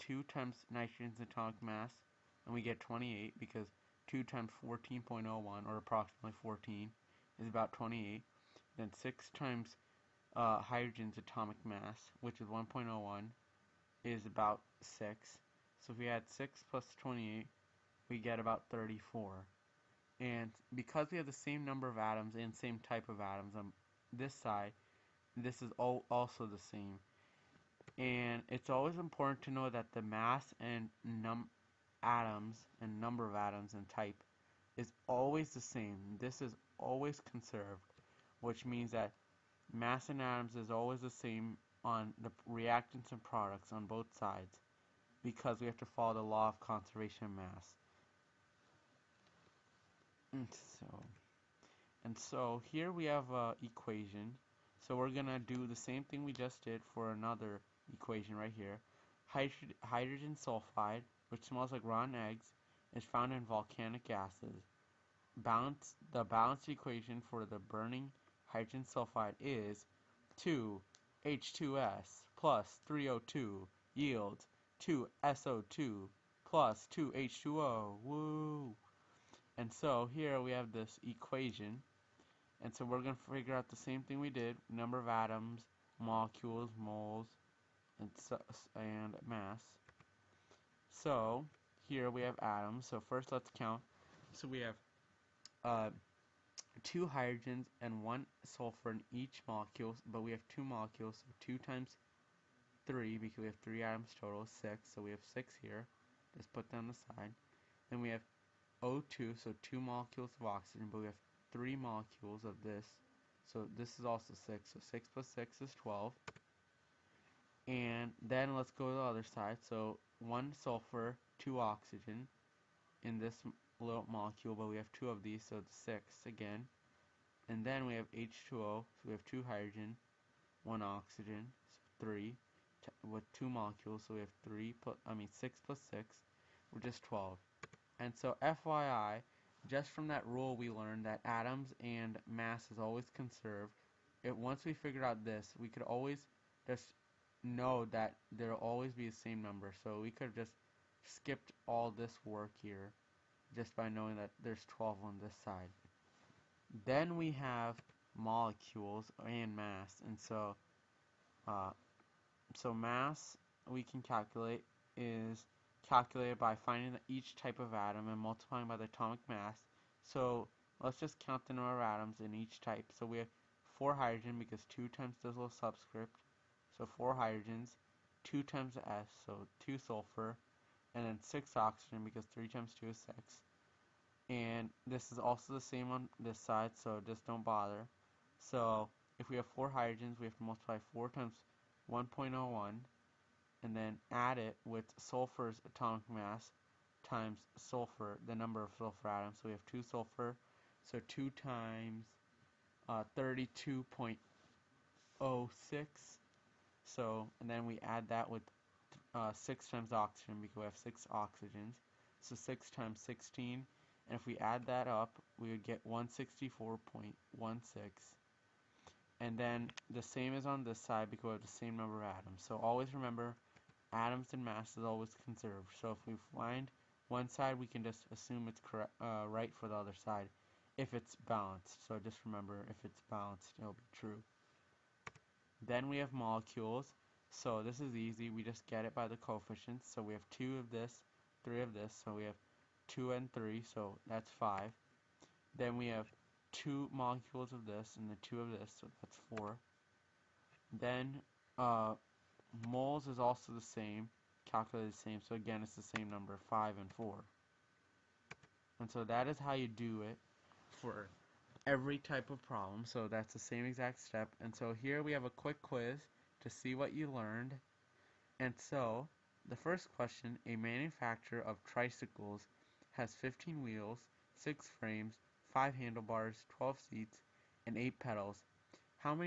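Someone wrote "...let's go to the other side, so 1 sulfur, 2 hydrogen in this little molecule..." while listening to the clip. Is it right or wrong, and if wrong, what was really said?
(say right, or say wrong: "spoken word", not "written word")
wrong: "oxygen", not "hydrogen".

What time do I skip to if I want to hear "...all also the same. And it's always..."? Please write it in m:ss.
0:25.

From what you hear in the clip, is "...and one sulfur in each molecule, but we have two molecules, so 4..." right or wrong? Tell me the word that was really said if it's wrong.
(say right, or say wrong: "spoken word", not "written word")
wrong: "2", not "4".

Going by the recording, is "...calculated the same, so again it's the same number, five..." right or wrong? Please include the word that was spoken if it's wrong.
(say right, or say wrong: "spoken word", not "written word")
right.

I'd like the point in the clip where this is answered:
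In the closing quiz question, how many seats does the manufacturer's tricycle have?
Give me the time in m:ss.
4:36.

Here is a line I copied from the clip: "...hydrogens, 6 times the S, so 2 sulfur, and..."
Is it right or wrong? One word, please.
wrong.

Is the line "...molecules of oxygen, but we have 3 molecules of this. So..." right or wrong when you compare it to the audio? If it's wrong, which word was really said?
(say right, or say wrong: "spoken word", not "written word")
right.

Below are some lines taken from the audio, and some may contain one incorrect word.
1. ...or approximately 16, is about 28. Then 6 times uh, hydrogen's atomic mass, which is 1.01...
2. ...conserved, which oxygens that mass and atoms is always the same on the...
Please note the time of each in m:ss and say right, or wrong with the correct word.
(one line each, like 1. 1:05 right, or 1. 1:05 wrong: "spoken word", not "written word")
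1. 0:05 wrong: "14", not "16"
2. 0:37 wrong: "means", not "oxygens".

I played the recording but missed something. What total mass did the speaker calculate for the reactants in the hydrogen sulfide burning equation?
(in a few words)
164.16.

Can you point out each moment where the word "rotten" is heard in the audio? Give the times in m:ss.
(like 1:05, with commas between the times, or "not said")
1:01.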